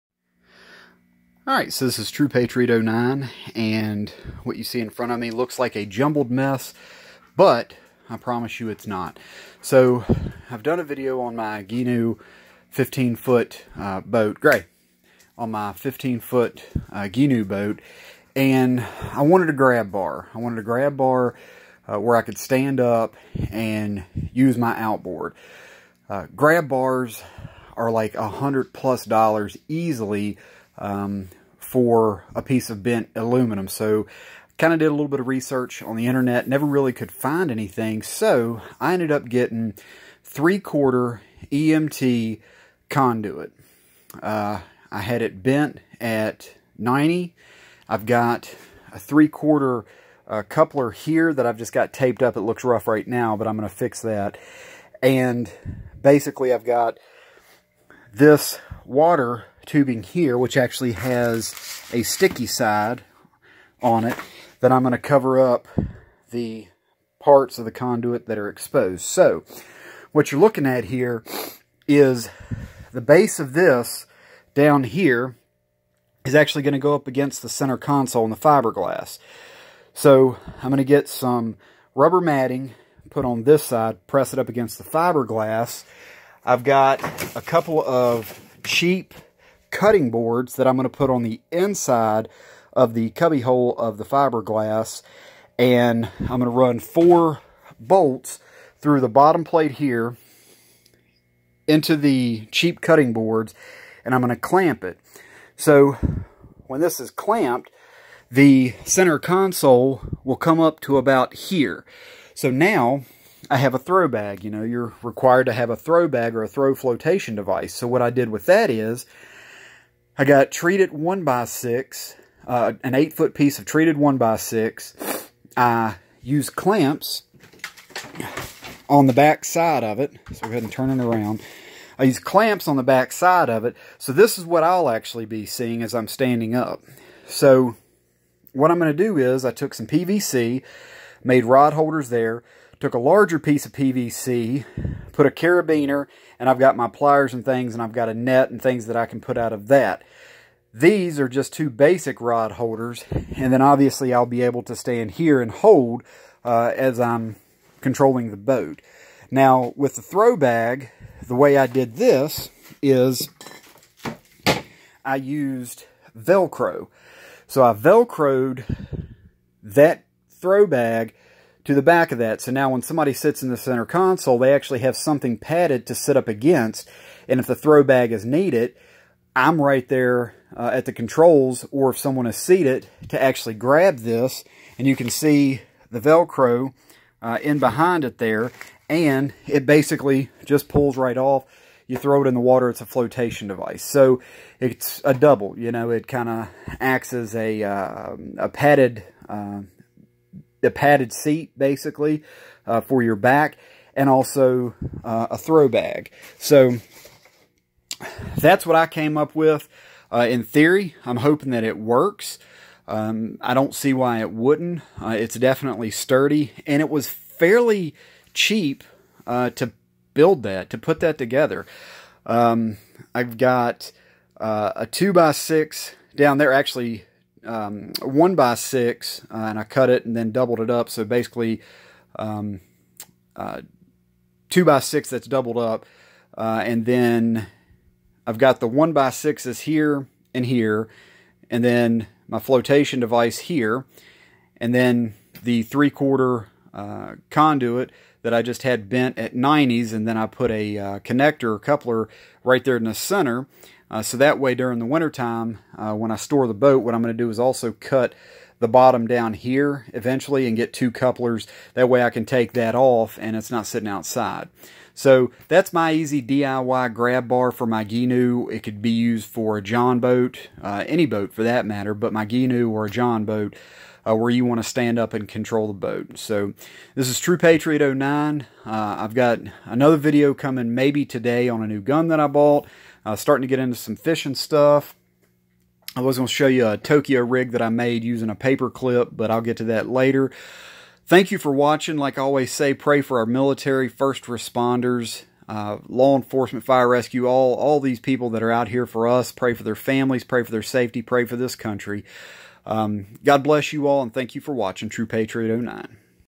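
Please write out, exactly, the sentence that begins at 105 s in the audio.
So when this is clamped, the center console will come up to about here.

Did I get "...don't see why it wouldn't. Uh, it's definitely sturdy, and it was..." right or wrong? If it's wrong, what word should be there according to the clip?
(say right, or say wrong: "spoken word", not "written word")
right.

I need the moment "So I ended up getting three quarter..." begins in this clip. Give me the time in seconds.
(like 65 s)
38 s.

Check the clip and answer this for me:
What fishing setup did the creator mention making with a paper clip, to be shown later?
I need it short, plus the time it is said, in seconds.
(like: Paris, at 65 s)
Tokyo rig, at 286 s.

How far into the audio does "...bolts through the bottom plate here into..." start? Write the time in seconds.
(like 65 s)
97 s.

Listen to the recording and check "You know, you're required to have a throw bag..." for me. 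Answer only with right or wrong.
right.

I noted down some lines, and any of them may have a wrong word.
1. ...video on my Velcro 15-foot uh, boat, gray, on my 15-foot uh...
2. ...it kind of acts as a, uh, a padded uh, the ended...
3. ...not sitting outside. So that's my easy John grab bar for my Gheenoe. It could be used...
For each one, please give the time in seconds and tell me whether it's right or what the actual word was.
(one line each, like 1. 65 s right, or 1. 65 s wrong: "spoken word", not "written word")
1. 10 s wrong: "Gheenoe", not "Velcro"
2. 195 s wrong: "padded", not "ended"
3. 263 s wrong: "DIY", not "John".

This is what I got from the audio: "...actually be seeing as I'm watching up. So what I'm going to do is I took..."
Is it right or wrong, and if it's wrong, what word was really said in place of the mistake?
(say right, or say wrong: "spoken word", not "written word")
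wrong: "standing", not "watching".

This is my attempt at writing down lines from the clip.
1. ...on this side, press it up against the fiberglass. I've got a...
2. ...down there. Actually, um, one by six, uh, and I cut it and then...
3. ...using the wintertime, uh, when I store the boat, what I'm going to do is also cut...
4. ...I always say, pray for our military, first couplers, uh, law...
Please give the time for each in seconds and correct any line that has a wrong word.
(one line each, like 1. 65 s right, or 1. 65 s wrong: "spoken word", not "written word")
1. 83 s right
2. 226 s right
3. 254 s wrong: "during", not "using"
4. 292 s wrong: "responders", not "couplers".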